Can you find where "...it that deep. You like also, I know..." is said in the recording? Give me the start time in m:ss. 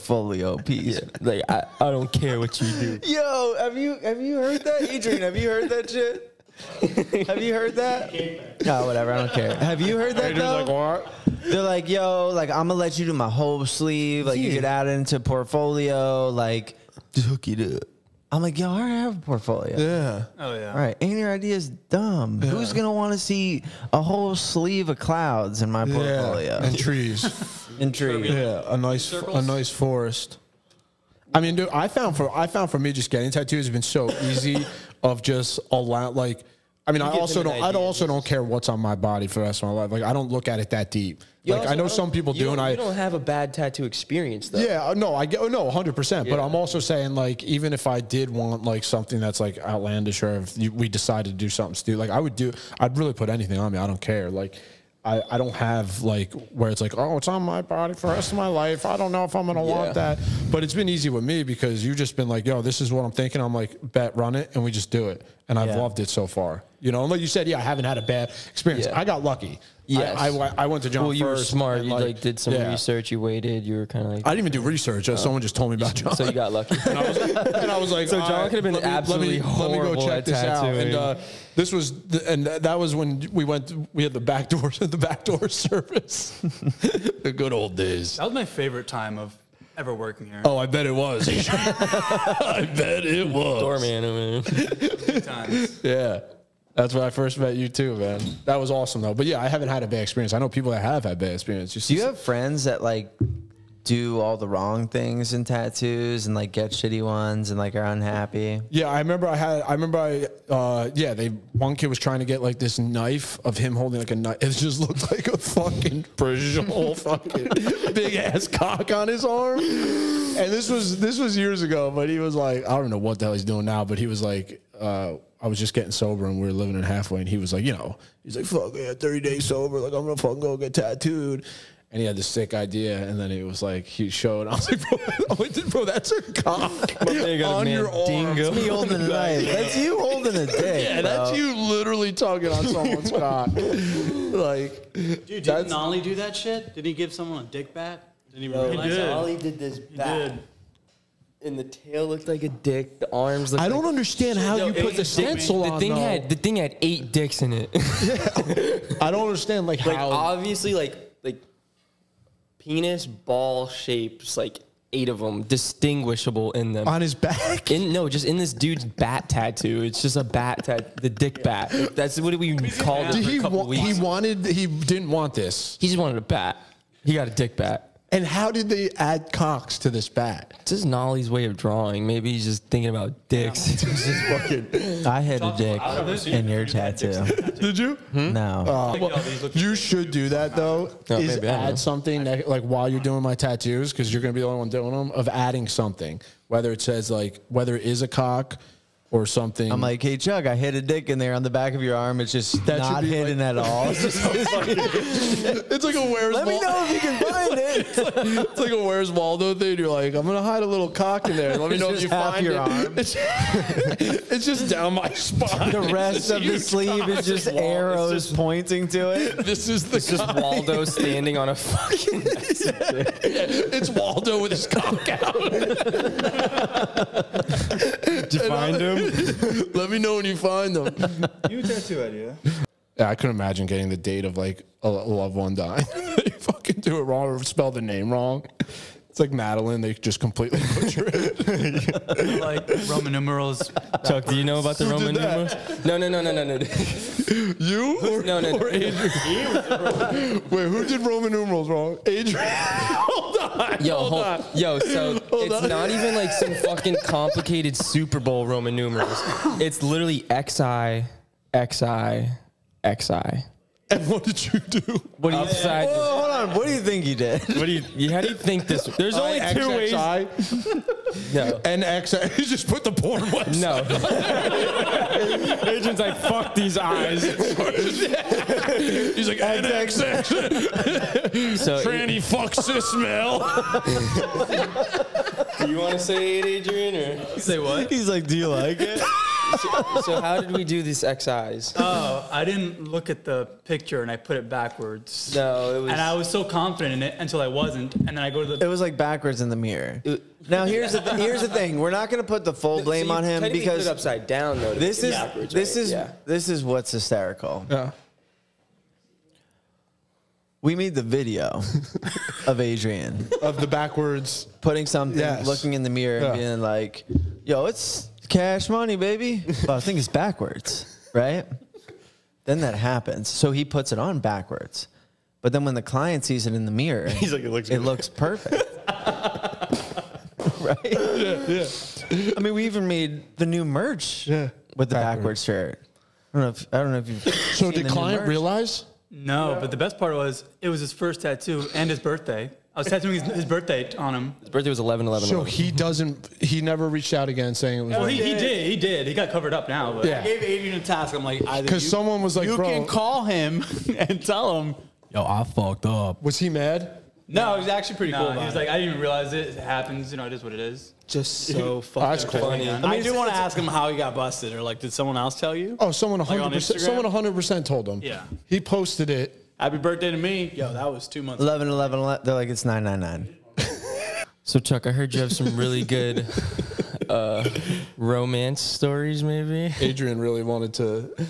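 0:40.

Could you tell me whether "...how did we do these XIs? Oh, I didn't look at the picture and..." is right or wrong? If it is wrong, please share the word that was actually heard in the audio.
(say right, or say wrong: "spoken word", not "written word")
right.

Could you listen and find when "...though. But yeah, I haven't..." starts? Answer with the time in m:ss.
1:39.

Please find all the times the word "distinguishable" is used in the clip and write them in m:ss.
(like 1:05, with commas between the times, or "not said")
2:45.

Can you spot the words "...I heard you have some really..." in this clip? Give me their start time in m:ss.
6:14.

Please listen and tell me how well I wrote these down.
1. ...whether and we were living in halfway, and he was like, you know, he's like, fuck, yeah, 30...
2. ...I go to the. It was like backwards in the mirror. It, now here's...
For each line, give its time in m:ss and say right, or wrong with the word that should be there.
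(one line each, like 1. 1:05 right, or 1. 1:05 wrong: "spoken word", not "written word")
1. 2:05 wrong: "sober", not "whether"
2. 4:58 right.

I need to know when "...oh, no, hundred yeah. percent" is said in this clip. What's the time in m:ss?
0:45.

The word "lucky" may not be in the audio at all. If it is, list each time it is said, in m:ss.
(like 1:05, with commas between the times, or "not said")
1:09, 1:16.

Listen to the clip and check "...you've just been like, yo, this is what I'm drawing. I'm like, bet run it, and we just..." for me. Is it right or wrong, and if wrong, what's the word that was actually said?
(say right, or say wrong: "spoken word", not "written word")
wrong: "thinking", not "drawing".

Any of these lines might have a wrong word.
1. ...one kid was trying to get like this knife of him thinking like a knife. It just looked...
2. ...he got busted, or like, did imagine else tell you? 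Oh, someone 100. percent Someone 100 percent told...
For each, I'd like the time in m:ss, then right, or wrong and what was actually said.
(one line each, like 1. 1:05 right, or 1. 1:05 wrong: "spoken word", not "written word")
1. 1:51 wrong: "holding", not "thinking"
2. 6:03 wrong: "someone", not "imagine".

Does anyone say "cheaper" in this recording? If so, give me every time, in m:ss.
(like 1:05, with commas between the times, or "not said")
not said.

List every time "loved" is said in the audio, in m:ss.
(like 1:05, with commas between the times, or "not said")
1:05, 3:54.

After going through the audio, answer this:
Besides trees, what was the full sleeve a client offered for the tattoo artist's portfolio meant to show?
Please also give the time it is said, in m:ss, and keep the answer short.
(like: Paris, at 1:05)
Clouds, at 0:24.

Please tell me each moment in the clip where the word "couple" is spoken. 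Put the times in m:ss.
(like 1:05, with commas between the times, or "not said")
2:53.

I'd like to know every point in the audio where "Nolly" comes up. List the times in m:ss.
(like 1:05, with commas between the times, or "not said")
2:25, 3:00.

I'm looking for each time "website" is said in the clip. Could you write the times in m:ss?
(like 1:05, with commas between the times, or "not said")
4:33.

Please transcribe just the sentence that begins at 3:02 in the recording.
Maybe he's just thinking about dicks.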